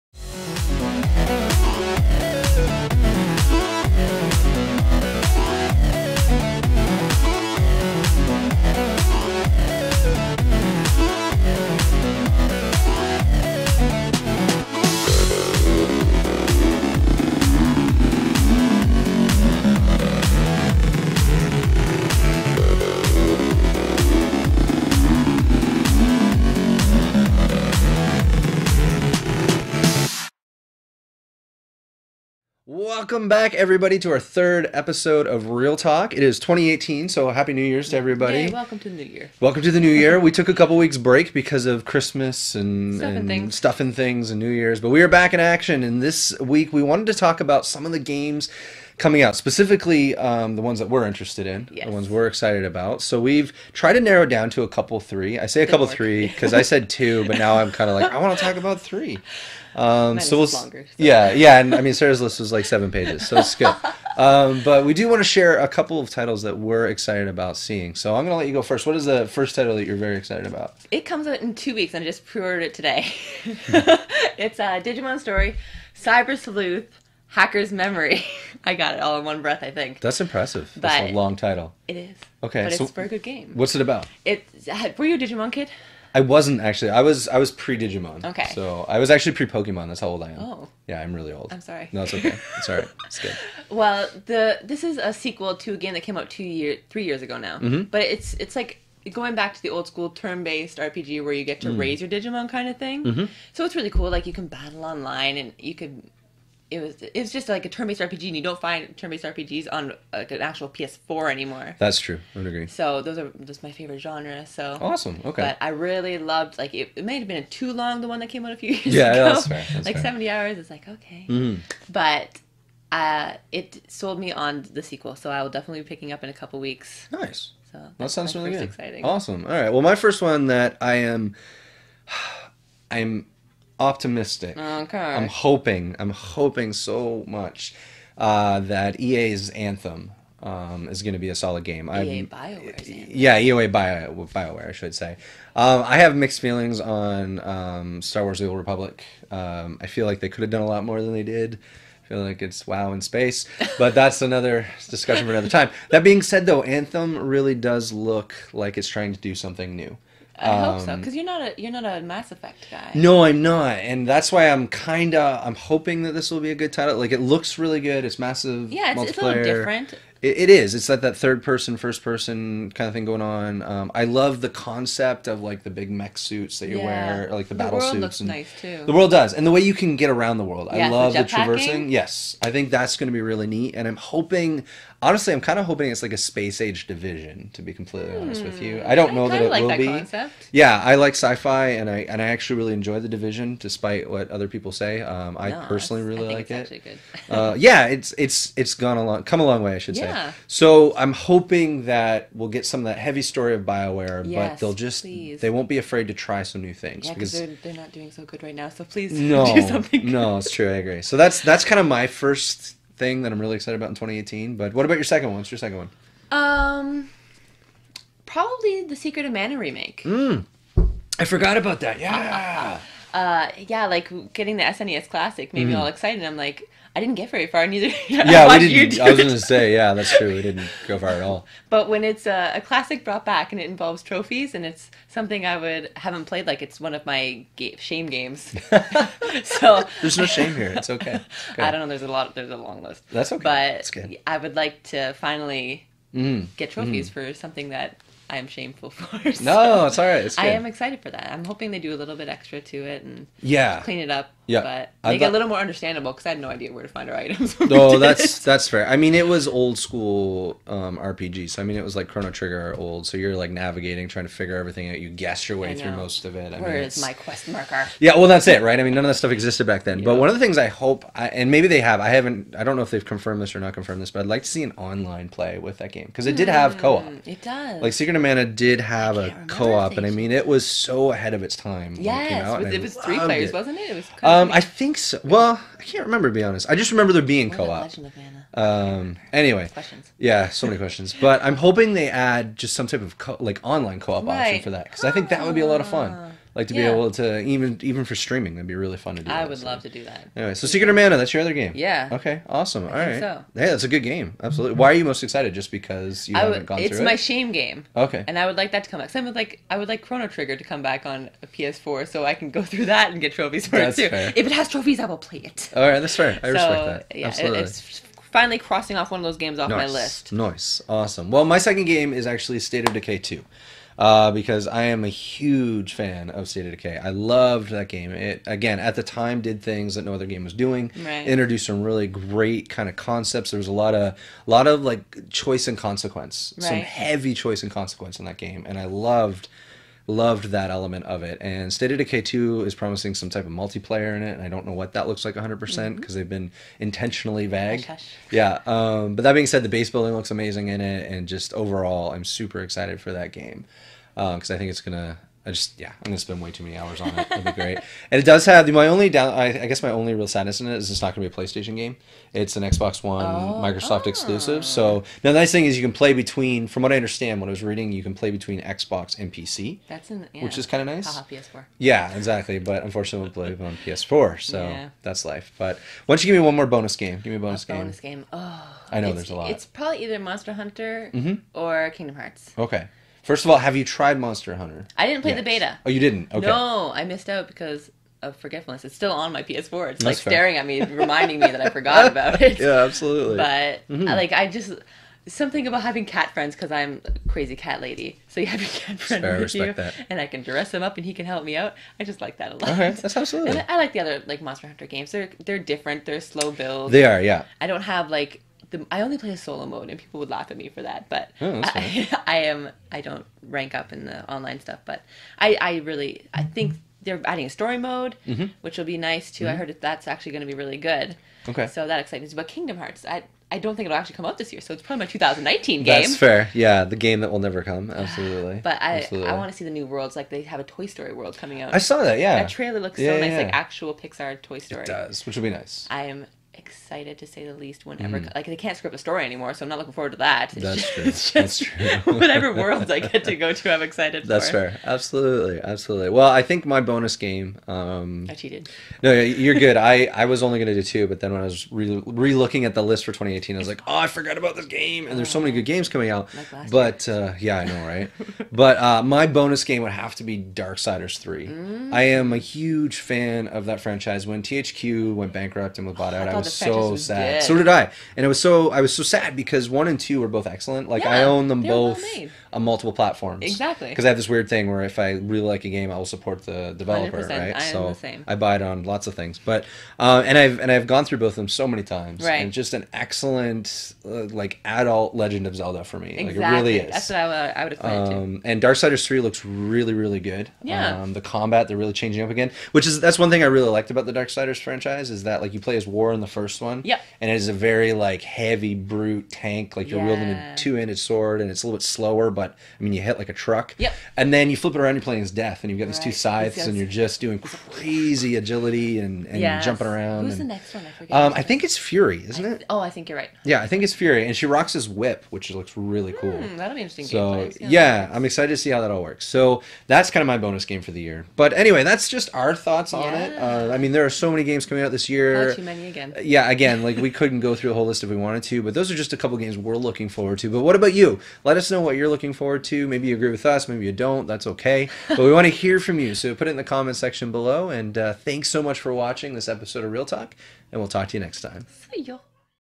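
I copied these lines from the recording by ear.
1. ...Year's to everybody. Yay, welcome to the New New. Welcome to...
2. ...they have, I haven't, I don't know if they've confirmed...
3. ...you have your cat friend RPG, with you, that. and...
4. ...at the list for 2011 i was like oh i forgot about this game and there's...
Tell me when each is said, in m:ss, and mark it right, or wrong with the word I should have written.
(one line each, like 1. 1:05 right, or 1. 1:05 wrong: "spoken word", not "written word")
1. 0:37 wrong: "Year", not "New"
2. 4:31 right
3. 6:38 wrong: "Fair", not "RPG"
4. 7:32 wrong: "2018", not "2011".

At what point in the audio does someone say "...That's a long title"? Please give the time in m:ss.
1:20.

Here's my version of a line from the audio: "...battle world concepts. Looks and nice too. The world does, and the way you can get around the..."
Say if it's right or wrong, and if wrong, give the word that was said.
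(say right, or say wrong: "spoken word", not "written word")
wrong: "suits", not "concepts".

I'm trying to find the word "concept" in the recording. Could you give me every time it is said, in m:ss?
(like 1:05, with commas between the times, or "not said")
2:54, 3:09, 5:32.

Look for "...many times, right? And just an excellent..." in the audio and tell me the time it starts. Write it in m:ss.
8:01.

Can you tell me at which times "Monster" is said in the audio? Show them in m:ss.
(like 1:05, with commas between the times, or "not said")
6:20, 6:24, 6:44.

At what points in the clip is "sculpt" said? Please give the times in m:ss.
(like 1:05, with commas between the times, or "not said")
not said.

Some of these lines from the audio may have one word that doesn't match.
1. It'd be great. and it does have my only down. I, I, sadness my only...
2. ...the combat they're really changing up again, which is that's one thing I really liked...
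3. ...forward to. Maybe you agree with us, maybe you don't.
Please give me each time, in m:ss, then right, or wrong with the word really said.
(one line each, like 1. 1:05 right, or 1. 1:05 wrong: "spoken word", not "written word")
1. 5:57 wrong: "guess", not "sadness"
2. 8:11 right
3. 8:52 right.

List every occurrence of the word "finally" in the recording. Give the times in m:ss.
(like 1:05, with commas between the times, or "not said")
4:05, 5:18.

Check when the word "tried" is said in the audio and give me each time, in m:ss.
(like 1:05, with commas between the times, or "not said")
0:53, 6:23.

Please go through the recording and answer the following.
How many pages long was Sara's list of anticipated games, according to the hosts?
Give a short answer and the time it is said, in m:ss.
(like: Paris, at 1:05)
7, at 1:02.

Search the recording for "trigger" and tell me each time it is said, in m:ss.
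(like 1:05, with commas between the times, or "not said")
4:22, 5:10.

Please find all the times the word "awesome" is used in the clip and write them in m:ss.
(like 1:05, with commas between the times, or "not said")
1:54, 2:09, 5:02, 5:20.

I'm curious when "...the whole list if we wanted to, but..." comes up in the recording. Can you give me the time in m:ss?
8:47.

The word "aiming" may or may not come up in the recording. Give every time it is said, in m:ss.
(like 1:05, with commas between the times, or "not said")
not said.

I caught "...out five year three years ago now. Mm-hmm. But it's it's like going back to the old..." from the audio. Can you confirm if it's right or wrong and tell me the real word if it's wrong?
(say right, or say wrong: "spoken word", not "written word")
wrong: "two", not "five".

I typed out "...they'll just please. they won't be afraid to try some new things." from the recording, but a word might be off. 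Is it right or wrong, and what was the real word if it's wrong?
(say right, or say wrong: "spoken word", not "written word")
right.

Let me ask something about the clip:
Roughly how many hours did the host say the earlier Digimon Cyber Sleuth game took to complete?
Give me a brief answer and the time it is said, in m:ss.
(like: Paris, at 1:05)
70, at 2:00.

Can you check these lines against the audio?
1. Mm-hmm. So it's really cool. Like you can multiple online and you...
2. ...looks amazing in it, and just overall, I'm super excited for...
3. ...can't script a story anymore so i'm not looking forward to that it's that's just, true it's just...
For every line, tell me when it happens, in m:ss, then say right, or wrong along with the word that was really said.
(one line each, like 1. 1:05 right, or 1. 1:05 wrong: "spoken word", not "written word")
1. 1:43 wrong: "battle", not "multiple"
2. 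5:50 right
3. 7:18 right.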